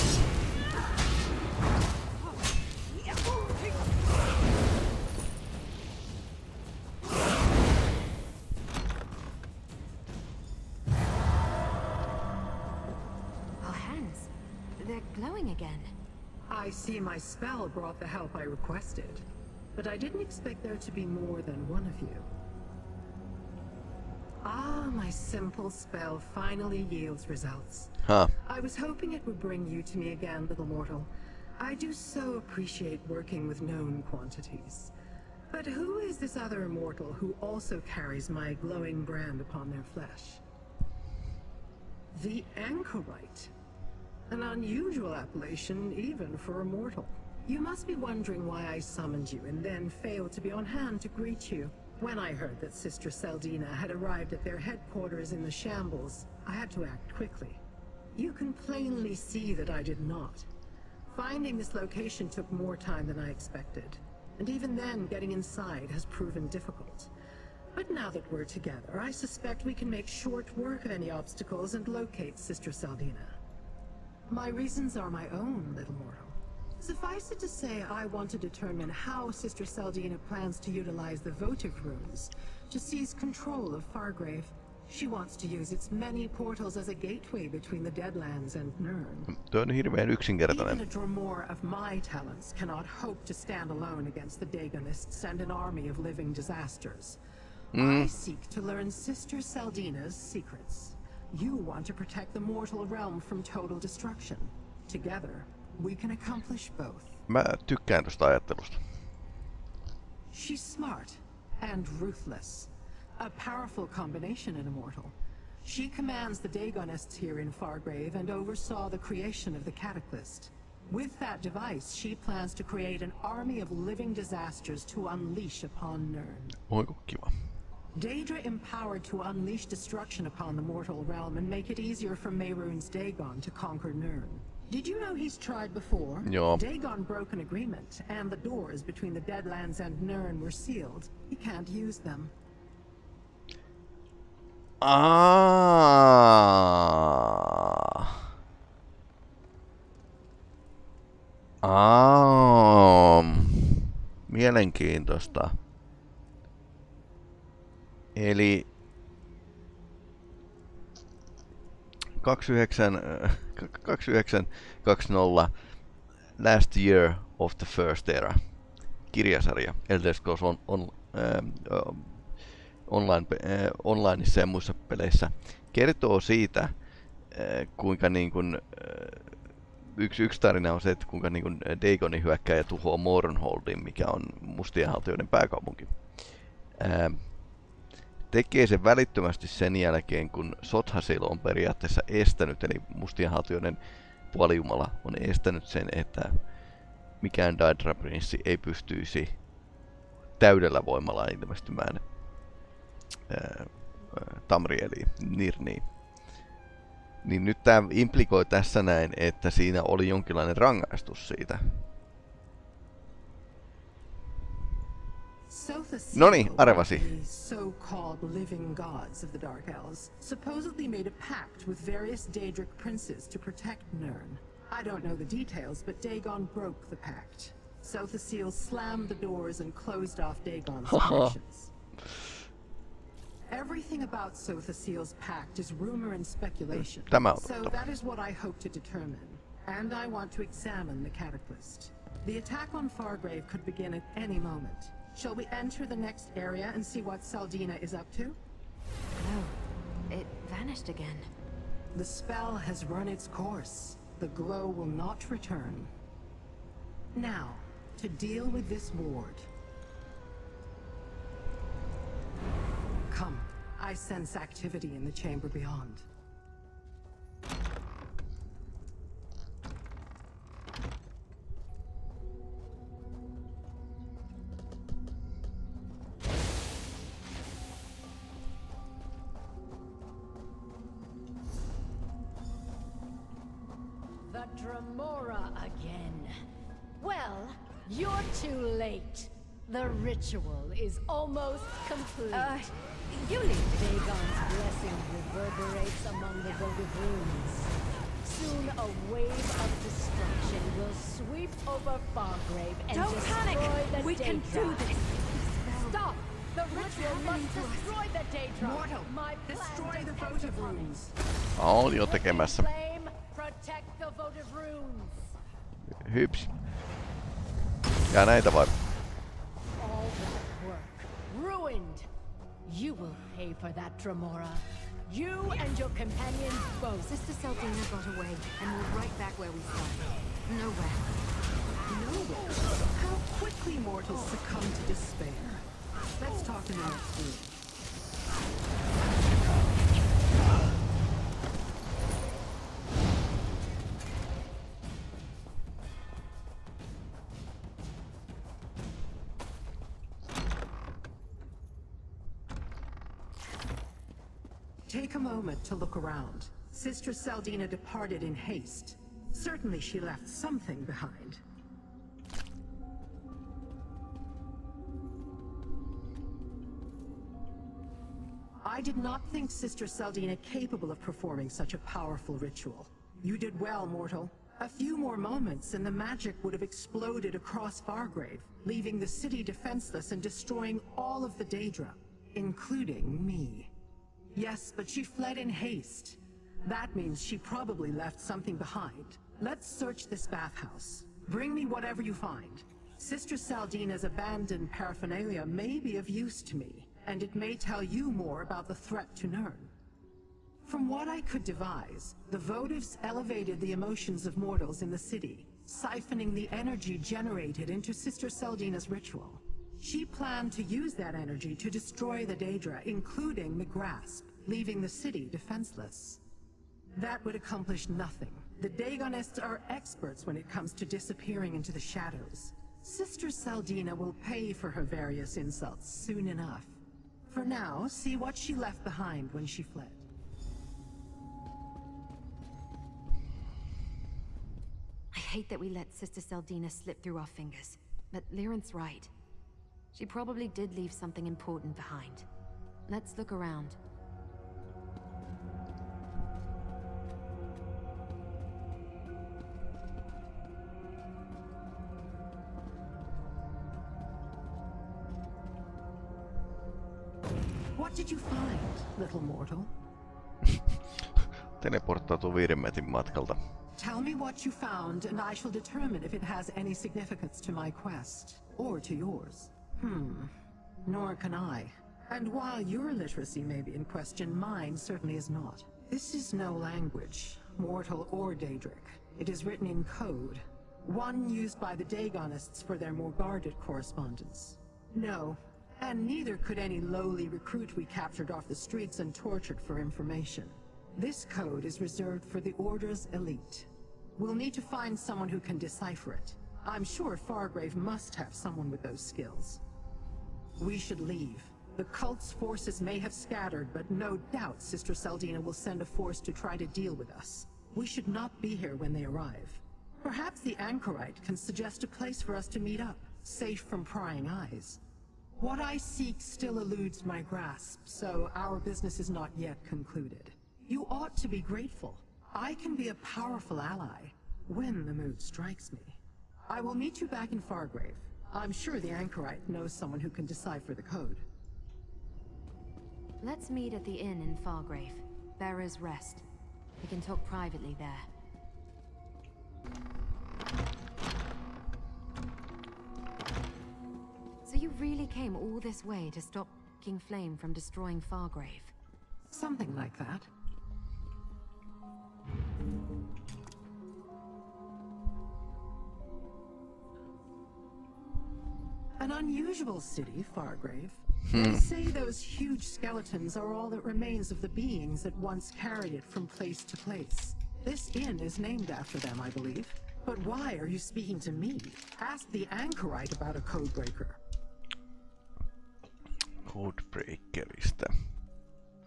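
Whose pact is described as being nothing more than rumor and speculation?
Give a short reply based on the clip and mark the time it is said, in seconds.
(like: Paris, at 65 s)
Sotha Sil, at 234 s.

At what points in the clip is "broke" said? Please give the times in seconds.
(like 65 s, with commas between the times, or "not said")
137 s, 226 s.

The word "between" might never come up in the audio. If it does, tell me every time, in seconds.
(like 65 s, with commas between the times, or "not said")
87 s, 138 s.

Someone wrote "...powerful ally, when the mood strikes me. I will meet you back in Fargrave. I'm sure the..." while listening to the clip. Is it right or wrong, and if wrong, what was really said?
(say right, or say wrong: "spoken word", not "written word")
right.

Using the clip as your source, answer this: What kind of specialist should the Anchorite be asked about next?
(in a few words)
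codebreaker.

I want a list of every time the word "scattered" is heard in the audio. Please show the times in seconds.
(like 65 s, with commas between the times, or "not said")
503 s.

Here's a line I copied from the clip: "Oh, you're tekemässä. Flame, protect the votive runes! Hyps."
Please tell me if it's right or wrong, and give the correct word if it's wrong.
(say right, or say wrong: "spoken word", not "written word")
right.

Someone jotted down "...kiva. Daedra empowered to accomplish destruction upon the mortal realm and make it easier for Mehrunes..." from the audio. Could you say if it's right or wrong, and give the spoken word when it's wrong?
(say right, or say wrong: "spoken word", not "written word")
wrong: "unleash", not "accomplish".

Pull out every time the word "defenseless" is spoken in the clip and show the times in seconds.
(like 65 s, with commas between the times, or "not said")
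379 s, 415 s.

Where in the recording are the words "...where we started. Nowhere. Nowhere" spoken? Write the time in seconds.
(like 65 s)
329 s.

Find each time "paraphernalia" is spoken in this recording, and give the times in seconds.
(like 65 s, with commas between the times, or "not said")
394 s.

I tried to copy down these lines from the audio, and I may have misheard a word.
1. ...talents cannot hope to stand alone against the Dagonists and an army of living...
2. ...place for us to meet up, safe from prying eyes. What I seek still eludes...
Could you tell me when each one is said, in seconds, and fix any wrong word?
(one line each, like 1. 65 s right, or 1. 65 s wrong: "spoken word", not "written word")
1. 91 s right
2. 511 s right.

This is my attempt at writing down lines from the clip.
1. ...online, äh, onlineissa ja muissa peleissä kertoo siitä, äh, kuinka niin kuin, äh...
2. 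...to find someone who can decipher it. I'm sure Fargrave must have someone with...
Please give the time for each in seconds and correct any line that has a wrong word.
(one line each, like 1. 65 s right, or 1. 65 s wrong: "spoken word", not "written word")
1. 172 s right
2. 494 s right.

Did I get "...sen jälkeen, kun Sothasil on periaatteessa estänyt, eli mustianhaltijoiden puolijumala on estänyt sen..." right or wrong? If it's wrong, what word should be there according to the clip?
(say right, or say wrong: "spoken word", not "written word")
right.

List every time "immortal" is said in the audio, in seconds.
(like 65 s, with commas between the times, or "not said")
36 s, 114 s.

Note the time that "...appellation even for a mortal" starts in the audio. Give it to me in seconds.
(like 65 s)
45 s.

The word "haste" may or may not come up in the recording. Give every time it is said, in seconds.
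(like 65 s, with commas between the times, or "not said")
358 s, 385 s.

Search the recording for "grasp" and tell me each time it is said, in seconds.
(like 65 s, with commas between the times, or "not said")
413 s, 517 s.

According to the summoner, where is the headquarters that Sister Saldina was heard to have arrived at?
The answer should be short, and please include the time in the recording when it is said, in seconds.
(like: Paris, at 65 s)
The Shambles, at 55 s.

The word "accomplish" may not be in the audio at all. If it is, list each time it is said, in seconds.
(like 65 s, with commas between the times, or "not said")
106 s, 417 s.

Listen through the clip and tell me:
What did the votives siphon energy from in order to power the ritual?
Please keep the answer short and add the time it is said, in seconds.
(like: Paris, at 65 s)
emotions of mortals, at 403 s.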